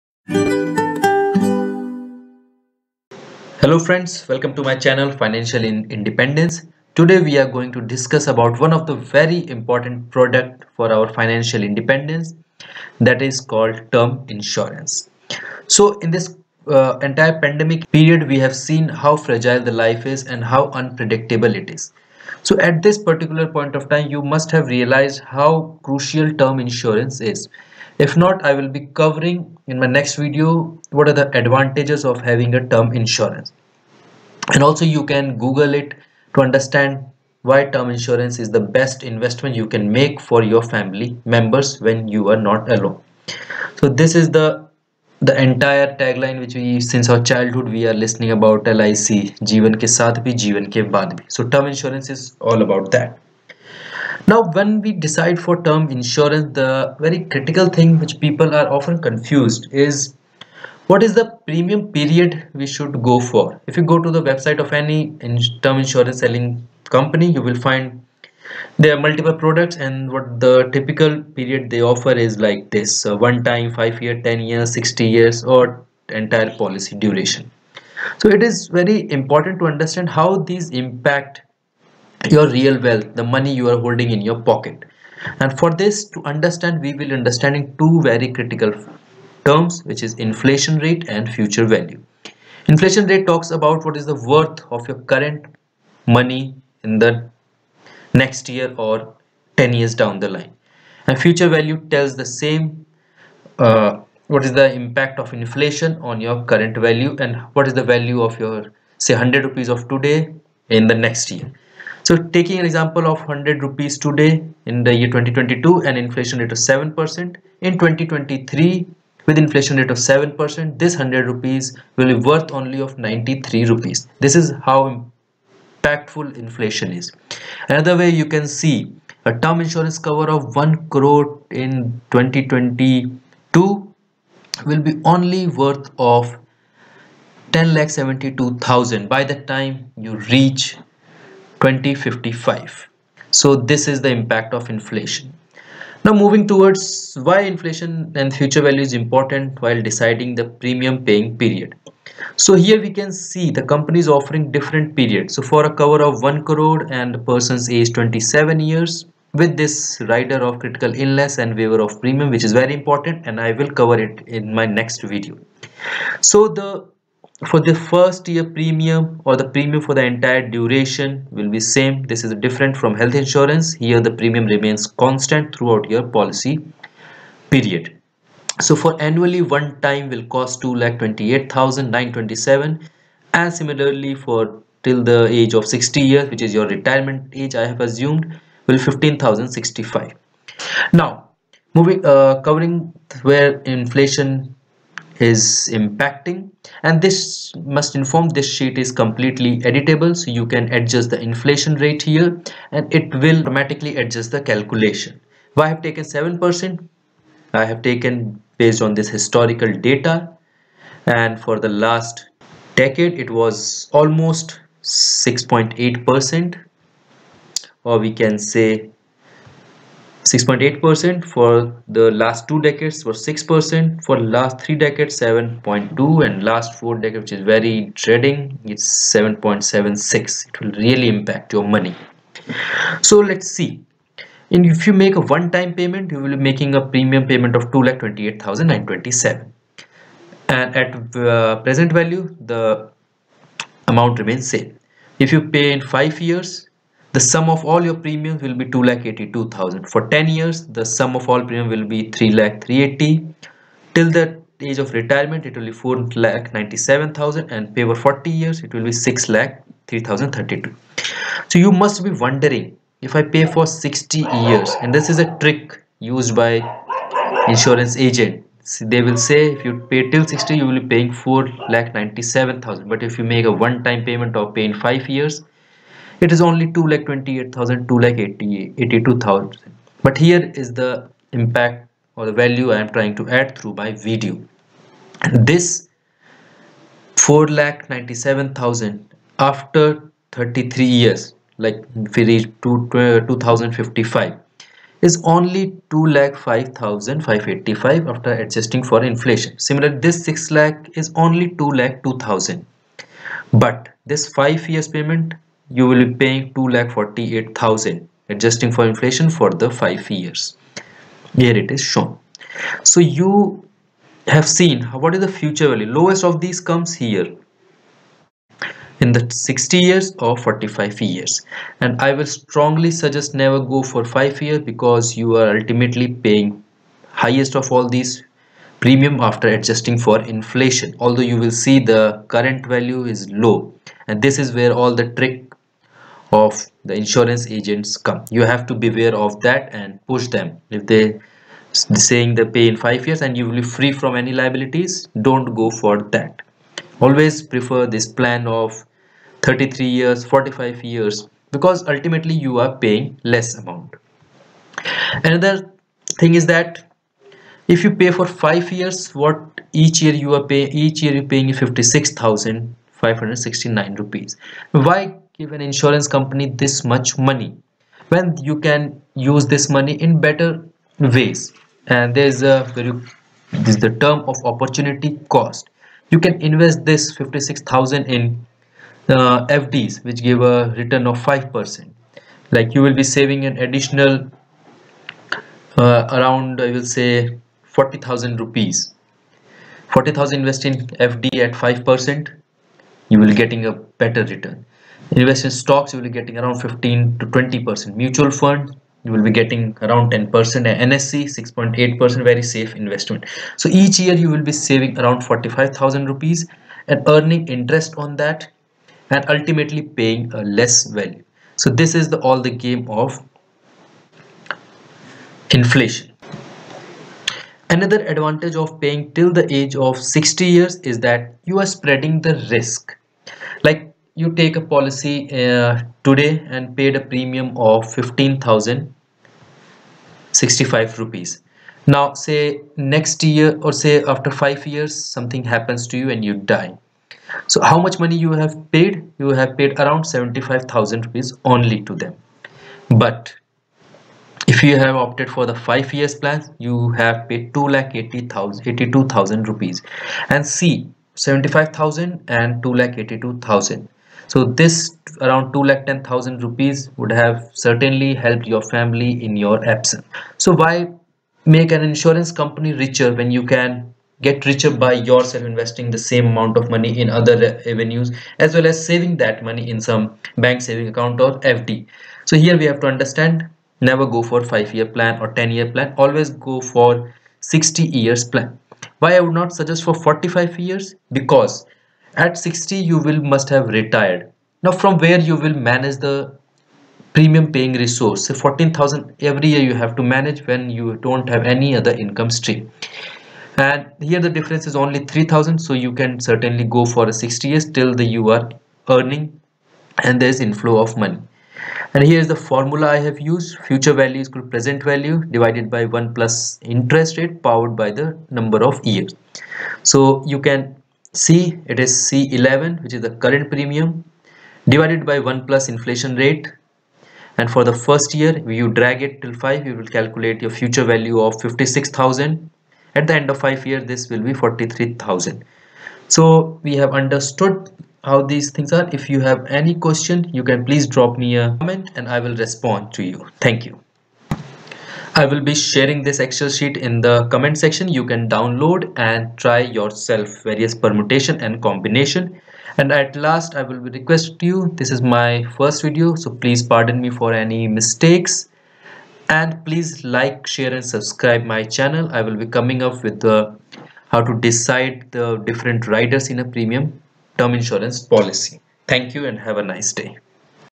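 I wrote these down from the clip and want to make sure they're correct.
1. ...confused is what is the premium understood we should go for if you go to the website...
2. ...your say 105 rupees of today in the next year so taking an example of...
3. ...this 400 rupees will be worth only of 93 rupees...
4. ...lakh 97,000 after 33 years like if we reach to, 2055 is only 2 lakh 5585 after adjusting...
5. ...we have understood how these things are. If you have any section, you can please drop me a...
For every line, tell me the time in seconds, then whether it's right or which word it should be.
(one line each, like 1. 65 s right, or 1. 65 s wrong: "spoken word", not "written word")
1. 59 s wrong: "period", not "understood"
2. 108 s wrong: "100", not "105"
3. 120 s wrong: "100", not "400"
4. 287 s right
5. 526 s wrong: "question", not "section".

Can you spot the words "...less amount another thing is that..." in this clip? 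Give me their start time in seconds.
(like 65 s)
353 s.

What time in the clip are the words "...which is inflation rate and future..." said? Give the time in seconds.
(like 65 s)
89 s.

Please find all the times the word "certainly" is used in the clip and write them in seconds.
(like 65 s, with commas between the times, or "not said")
457 s, 496 s.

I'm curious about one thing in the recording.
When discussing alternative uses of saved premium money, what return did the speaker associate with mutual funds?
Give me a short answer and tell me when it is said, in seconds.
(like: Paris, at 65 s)
10 percent, at 400 s.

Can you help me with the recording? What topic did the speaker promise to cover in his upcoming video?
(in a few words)
different riders.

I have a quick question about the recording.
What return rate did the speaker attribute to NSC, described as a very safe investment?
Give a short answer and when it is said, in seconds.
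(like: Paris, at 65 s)
6.8 percent, at 401 s.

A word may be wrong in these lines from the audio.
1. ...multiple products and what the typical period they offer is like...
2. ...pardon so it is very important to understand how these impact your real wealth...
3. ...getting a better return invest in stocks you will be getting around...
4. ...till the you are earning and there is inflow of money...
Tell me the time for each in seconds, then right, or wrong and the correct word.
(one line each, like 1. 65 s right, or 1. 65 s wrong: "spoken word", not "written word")
1. 68 s right
2. 76 s wrong: "duration", not "pardon"
3. 393 s right
4. 497 s right.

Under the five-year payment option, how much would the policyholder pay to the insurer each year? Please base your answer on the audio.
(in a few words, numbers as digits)
56,569 rupees.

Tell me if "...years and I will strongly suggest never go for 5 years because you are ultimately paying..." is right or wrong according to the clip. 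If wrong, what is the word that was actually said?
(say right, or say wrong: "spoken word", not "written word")
right.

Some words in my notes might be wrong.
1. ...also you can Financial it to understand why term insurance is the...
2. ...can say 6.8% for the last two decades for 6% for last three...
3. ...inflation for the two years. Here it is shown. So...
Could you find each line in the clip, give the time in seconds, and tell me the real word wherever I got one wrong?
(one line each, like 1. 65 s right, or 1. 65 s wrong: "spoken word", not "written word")
1. 34 s wrong: "Google", not "Financial"
2. 218 s right
3. 308 s wrong: "five", not "two".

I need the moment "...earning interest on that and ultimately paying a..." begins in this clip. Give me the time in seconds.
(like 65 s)
407 s.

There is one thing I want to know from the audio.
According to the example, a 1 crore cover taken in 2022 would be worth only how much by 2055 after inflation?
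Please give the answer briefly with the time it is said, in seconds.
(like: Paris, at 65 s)
10 lakh 72,000, at 137 s.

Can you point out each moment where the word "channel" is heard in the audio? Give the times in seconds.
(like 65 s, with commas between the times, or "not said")
4 s, 551 s.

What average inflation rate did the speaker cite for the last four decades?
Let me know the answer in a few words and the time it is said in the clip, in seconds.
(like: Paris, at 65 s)
7.76%, at 229 s.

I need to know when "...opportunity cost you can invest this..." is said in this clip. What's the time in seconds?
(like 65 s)
374 s.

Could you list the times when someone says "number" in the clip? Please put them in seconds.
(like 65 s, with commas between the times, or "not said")
508 s.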